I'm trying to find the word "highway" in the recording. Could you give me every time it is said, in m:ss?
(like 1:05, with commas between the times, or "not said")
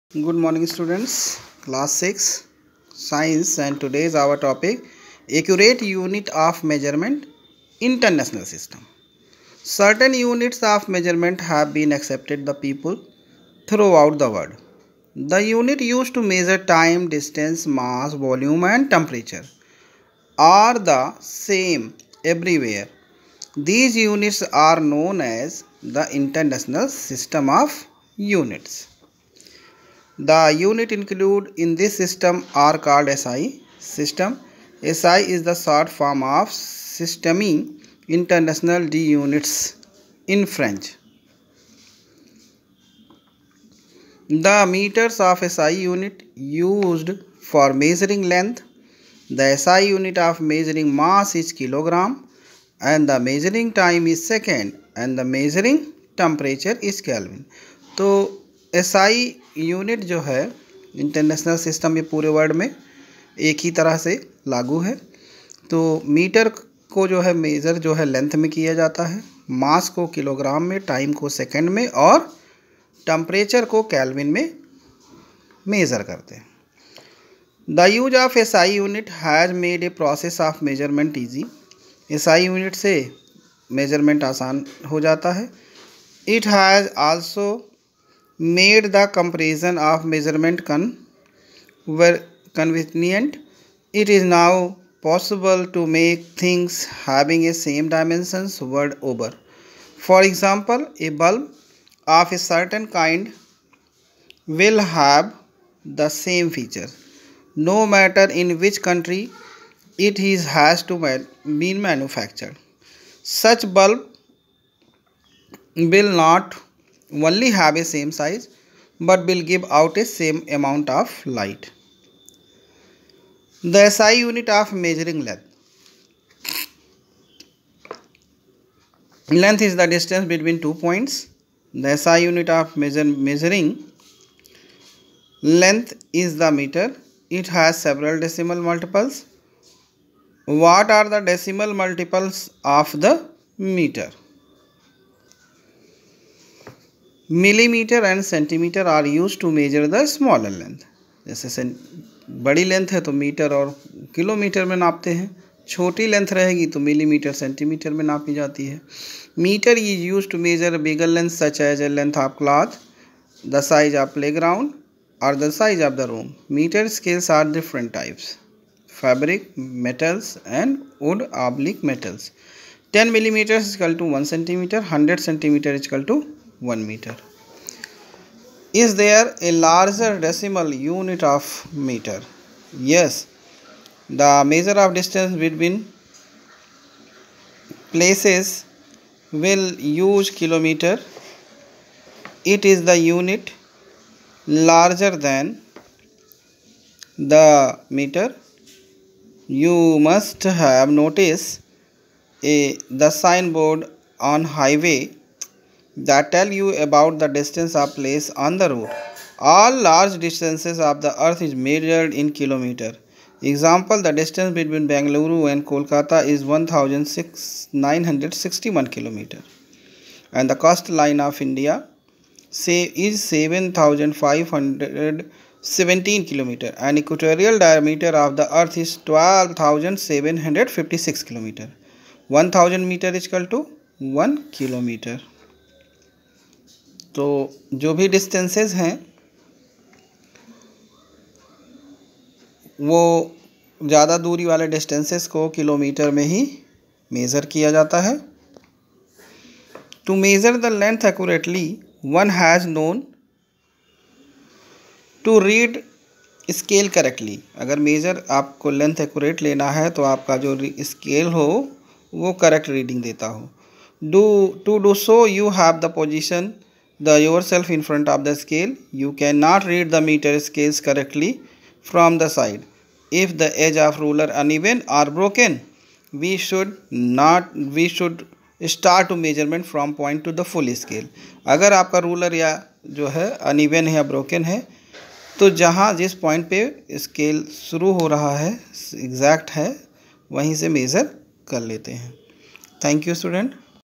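3:24.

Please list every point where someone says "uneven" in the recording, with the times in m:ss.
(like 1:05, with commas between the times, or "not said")
4:34, 4:43.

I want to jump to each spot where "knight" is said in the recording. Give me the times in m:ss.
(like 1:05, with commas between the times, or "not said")
not said.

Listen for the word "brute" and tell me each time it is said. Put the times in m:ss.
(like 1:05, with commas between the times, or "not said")
not said.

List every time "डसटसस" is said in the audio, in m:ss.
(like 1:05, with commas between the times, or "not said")
3:58, 4:04.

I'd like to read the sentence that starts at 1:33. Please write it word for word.
It is now possible to make things having a same dimensions word over.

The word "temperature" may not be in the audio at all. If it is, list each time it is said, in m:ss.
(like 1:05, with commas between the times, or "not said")
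0:18, 0:56.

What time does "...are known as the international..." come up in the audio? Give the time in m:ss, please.
0:24.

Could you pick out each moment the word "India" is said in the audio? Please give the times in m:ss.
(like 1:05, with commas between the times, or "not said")
3:41.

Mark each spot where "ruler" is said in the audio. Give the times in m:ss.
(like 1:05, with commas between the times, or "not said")
4:34, 4:42.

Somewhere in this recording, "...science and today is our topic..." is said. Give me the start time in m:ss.
0:03.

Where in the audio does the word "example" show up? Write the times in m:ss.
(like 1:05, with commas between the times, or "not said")
1:40, 3:33.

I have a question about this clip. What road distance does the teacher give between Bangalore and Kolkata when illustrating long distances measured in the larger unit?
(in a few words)
1961 km.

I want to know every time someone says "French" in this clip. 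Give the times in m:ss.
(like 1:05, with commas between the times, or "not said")
0:40.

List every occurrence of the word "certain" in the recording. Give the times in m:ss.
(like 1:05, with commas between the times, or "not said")
0:09, 1:42.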